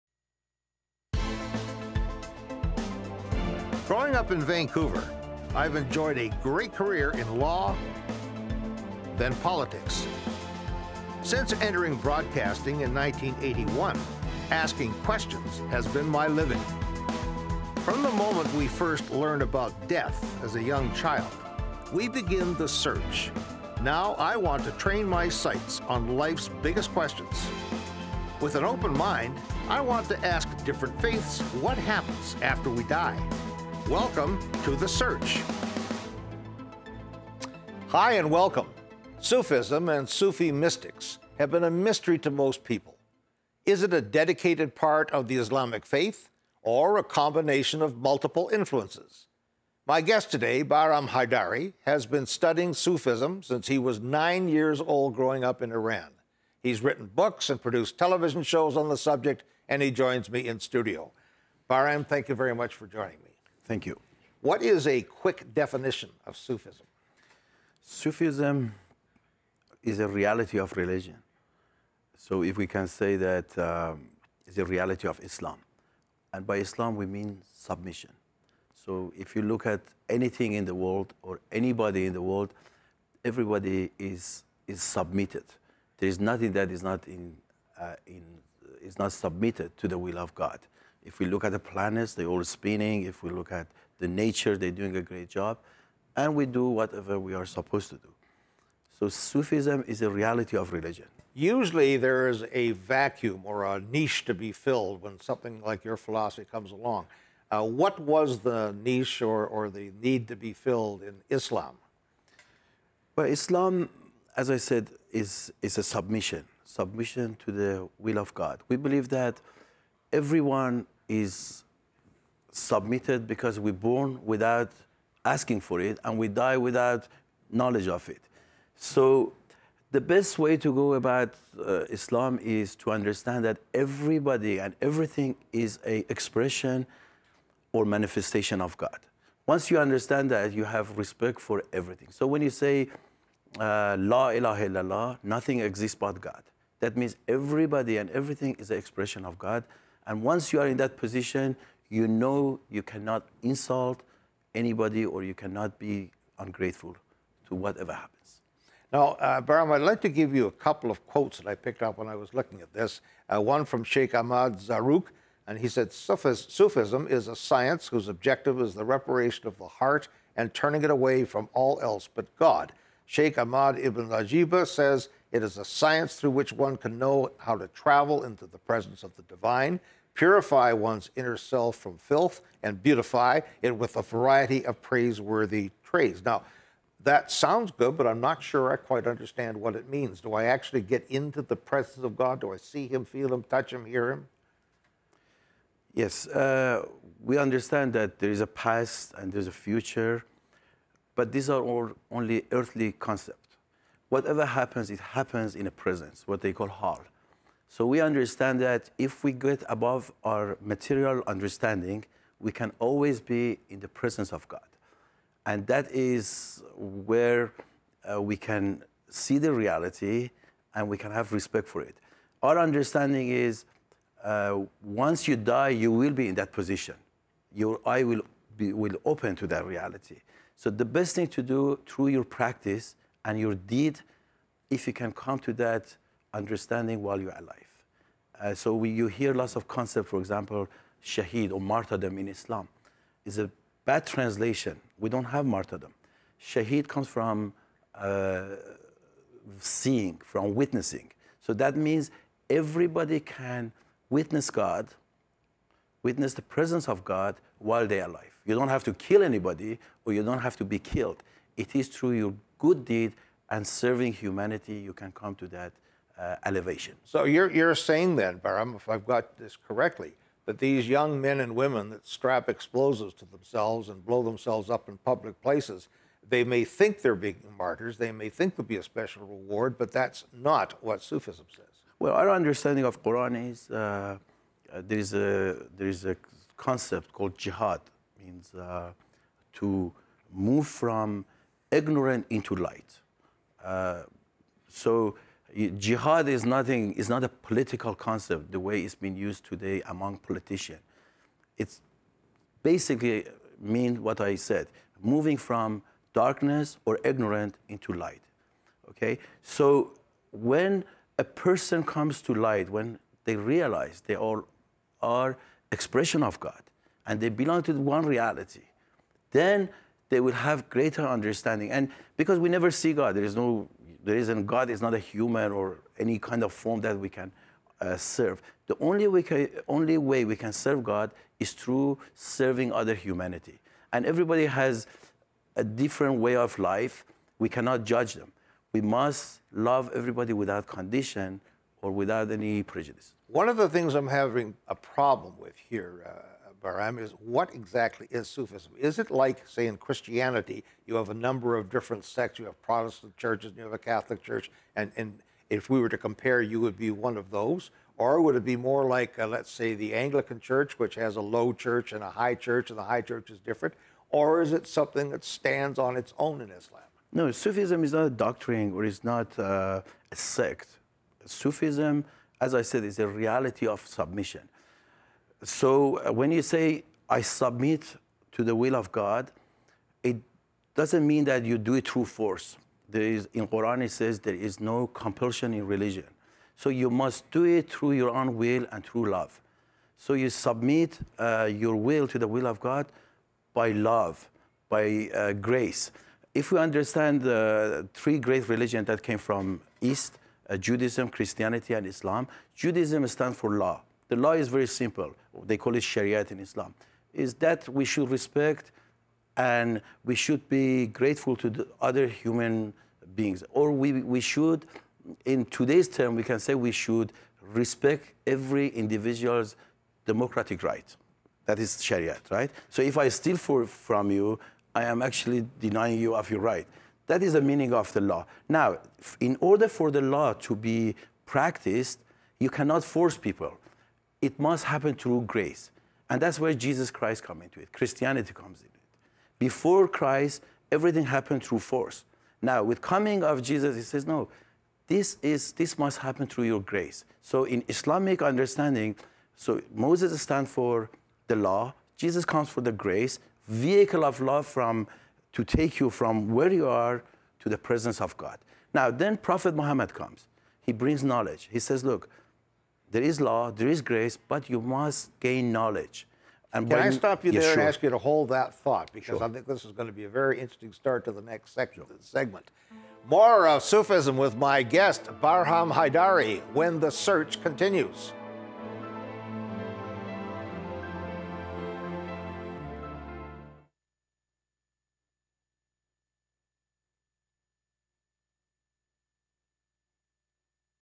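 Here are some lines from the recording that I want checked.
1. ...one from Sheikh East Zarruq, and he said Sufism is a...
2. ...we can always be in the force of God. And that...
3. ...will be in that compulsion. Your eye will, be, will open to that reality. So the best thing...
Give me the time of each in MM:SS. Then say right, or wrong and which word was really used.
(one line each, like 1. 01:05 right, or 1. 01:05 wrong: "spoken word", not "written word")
1. 02:43 wrong: "Ahmad", not "East"
2. 03:32 wrong: "presence", not "force"
3. 03:45 wrong: "position", not "compulsion".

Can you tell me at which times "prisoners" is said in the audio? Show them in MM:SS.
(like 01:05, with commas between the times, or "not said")
not said.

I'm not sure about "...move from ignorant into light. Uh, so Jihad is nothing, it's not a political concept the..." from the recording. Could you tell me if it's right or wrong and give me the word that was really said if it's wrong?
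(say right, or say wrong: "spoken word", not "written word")
right.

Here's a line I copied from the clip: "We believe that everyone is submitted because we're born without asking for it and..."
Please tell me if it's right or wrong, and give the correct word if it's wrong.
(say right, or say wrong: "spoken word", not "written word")
right.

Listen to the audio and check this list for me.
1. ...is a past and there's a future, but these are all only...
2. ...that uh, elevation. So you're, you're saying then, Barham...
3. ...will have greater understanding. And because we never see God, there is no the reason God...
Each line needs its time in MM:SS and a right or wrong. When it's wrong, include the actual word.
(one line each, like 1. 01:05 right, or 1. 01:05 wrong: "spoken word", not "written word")
1. 03:18 right
2. 04:25 right
3. 05:20 right.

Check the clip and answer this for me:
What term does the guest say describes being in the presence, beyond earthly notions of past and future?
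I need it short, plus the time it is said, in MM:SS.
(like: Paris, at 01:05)
hal, at 03:26.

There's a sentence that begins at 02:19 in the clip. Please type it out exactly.
Once you understand that, you have respect for everything.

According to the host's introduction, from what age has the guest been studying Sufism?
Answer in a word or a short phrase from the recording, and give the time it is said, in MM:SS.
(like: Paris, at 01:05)
9, at 00:53.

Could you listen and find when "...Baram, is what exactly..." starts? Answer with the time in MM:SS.
05:46.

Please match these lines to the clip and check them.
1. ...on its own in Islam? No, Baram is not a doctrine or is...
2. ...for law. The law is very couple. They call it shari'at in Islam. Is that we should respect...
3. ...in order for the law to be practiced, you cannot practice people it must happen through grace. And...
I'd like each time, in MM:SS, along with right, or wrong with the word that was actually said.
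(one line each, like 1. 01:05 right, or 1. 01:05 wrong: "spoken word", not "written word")
1. 06:05 wrong: "Sufism", not "Baram"
2. 06:43 wrong: "simple", not "couple"
3. 07:09 wrong: "force", not "practice".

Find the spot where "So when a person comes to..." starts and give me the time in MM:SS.
05:09.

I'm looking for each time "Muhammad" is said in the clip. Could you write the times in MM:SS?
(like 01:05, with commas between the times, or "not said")
07:39.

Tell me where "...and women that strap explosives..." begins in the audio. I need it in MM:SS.
04:31.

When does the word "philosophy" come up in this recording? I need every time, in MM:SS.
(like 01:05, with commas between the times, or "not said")
01:45.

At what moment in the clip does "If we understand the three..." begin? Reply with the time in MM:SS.
06:36.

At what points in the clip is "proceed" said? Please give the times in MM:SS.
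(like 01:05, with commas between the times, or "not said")
not said.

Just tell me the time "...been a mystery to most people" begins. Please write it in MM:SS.
00:41.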